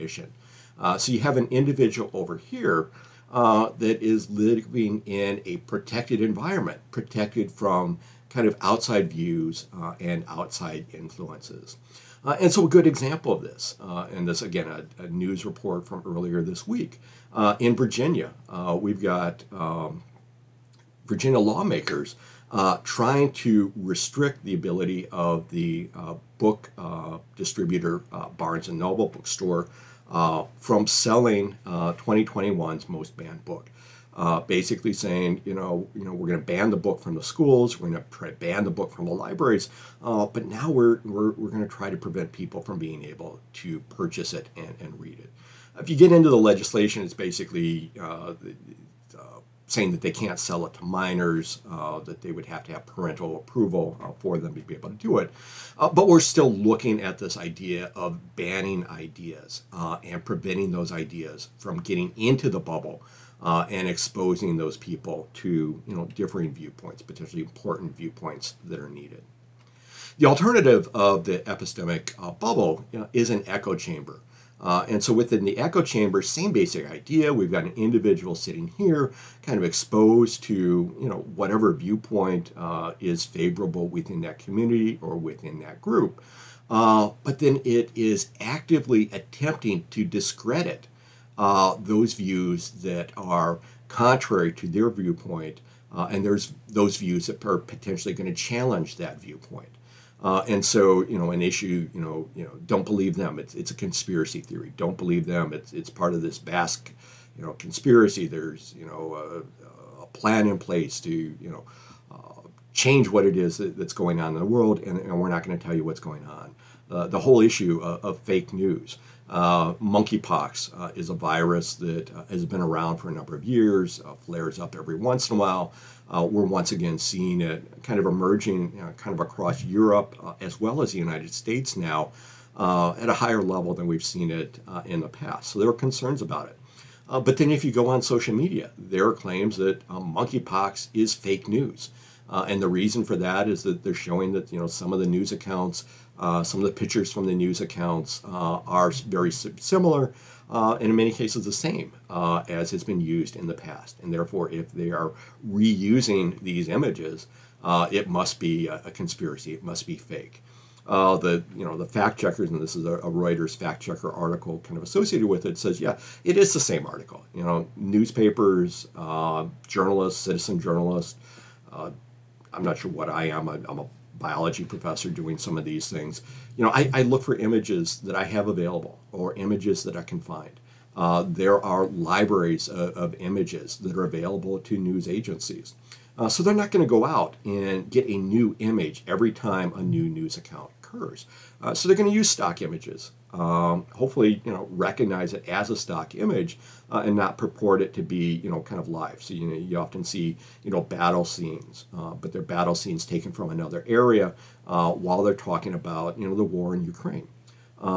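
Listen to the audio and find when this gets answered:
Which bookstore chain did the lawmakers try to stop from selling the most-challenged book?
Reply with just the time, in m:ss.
0:28.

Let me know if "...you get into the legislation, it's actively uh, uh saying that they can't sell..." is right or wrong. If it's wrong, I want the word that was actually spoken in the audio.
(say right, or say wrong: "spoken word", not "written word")
wrong: "basically", not "actively".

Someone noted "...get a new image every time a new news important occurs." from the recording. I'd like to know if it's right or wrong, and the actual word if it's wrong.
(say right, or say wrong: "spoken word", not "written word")
wrong: "account", not "important".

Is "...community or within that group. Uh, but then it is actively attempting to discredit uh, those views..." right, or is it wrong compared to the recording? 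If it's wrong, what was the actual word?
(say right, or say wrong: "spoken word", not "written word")
right.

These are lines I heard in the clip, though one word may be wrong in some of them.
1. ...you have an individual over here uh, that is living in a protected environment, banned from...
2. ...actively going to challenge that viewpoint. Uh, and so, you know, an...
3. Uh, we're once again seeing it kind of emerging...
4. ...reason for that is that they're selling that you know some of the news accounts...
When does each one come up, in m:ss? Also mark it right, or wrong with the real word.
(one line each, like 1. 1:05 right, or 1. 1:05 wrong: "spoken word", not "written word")
1. 0:01 wrong: "protected", not "banned"
2. 1:37 wrong: "potentially", not "actively"
3. 2:06 right
4. 2:22 wrong: "showing", not "selling".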